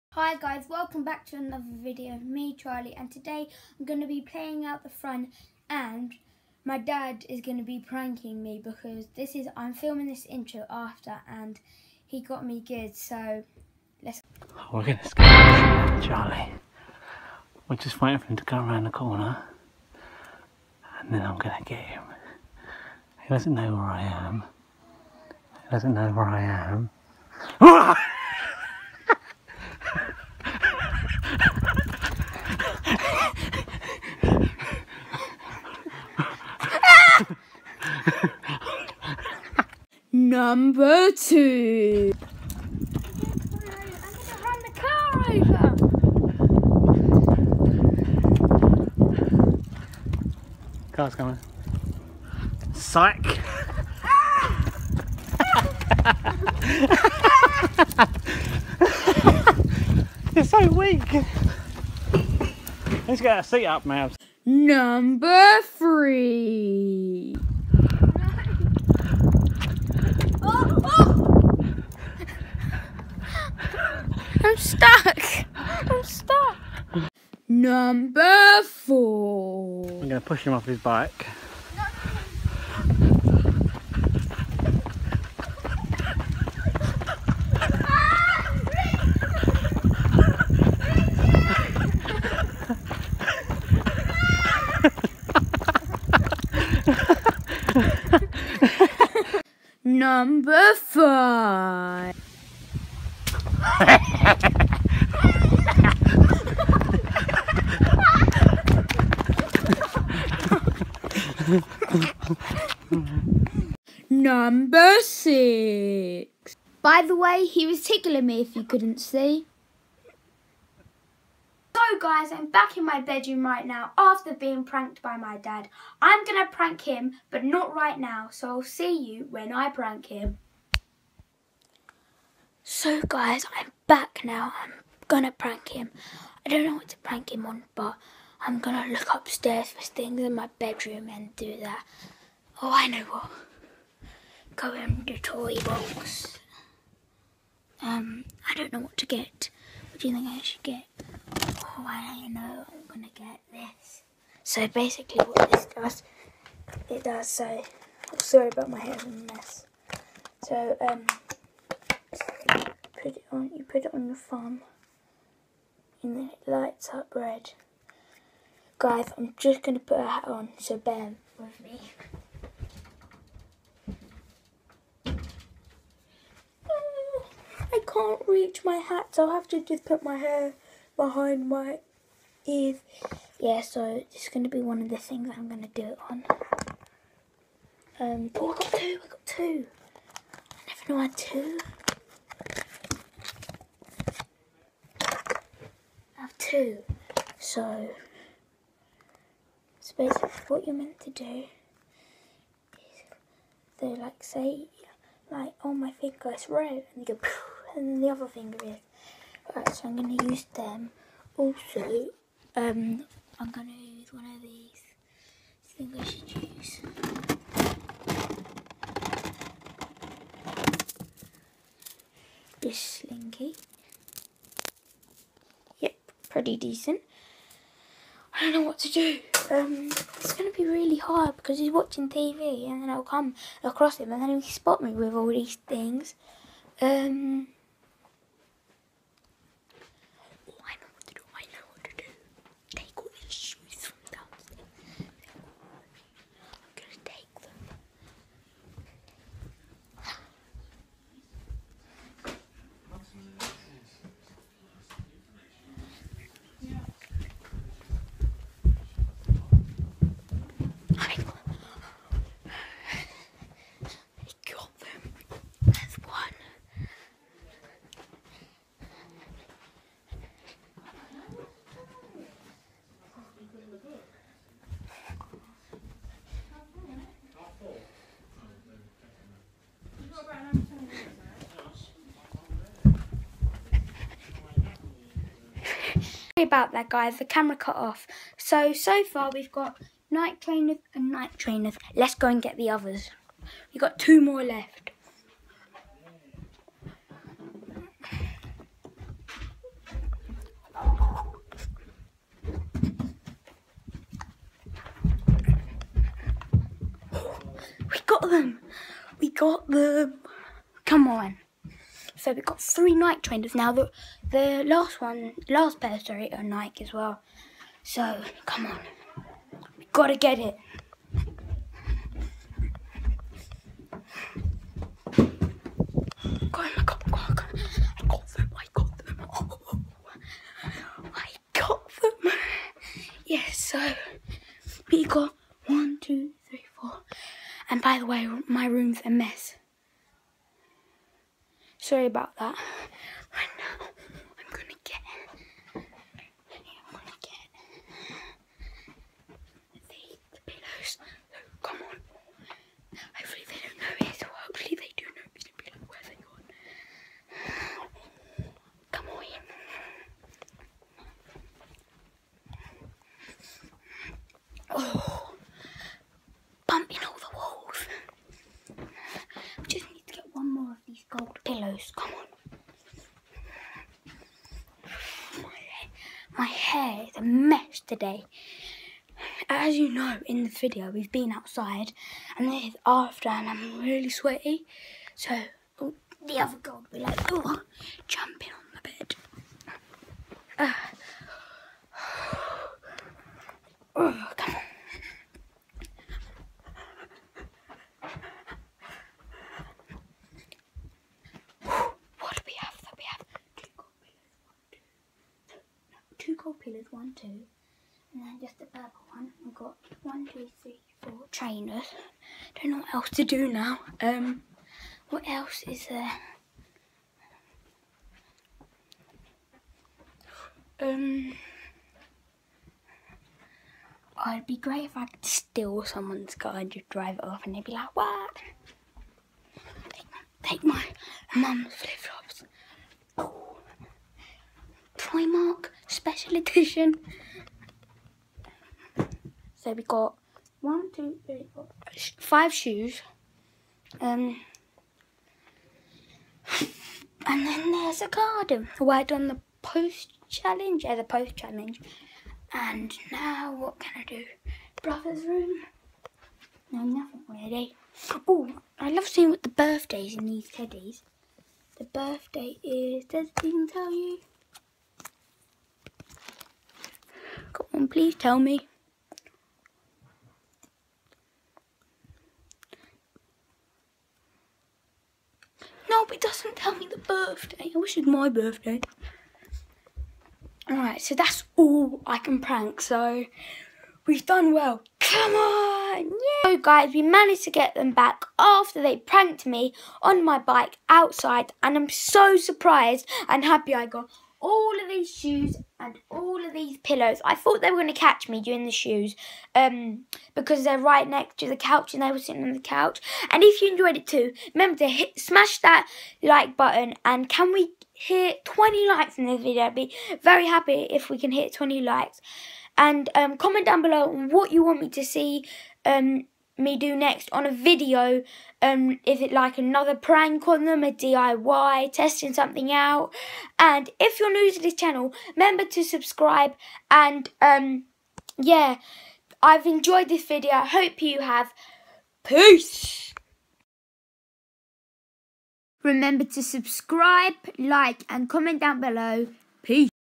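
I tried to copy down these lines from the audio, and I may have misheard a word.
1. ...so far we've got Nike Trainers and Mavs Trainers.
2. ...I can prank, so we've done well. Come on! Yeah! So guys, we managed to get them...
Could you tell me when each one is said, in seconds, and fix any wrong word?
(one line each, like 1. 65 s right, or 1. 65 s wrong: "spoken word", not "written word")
1. 288 s wrong: "Nike", not "Mavs"
2. 482 s right.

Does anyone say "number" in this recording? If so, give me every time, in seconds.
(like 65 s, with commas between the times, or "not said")
40 s, 64 s, 77 s, 99 s, 114 s.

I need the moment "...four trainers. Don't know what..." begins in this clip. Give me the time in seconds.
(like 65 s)
411 s.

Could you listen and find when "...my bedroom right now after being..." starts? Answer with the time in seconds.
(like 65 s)
122 s.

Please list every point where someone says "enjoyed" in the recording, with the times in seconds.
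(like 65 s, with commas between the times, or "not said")
503 s, 529 s.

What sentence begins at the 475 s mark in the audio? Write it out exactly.
No, but it doesn't tell me the birthday.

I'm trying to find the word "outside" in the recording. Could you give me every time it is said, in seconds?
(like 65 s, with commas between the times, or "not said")
381 s, 490 s.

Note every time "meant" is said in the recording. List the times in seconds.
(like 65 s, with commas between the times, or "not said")
200 s.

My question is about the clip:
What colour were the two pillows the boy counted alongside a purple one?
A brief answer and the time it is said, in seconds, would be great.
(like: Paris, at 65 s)
gold, at 406 s.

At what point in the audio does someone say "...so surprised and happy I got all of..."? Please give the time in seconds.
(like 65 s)
491 s.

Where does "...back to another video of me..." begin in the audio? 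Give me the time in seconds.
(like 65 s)
1 s.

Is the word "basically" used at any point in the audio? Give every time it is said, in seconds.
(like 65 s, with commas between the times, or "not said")
154 s, 199 s.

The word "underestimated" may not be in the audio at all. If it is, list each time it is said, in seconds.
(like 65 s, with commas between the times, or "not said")
not said.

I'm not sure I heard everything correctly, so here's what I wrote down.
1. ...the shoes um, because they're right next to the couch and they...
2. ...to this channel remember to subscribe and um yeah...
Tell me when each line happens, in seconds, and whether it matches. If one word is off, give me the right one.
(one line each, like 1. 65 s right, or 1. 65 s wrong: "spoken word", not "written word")
1. 498 s right
2. 524 s right.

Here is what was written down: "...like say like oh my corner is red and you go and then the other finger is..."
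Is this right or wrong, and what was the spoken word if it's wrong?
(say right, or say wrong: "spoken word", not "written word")
wrong: "finger", not "corner".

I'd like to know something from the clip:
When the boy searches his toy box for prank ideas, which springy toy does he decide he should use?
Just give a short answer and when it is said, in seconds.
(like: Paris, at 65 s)
slinky, at 222 s.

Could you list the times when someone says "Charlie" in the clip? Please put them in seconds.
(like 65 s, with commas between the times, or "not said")
2 s, 16 s.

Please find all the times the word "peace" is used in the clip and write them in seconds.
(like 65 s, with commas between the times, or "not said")
532 s, 539 s.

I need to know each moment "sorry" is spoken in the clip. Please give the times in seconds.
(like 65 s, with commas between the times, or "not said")
158 s, 286 s, 315 s, 341 s.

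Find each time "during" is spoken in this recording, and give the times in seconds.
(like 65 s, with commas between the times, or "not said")
498 s.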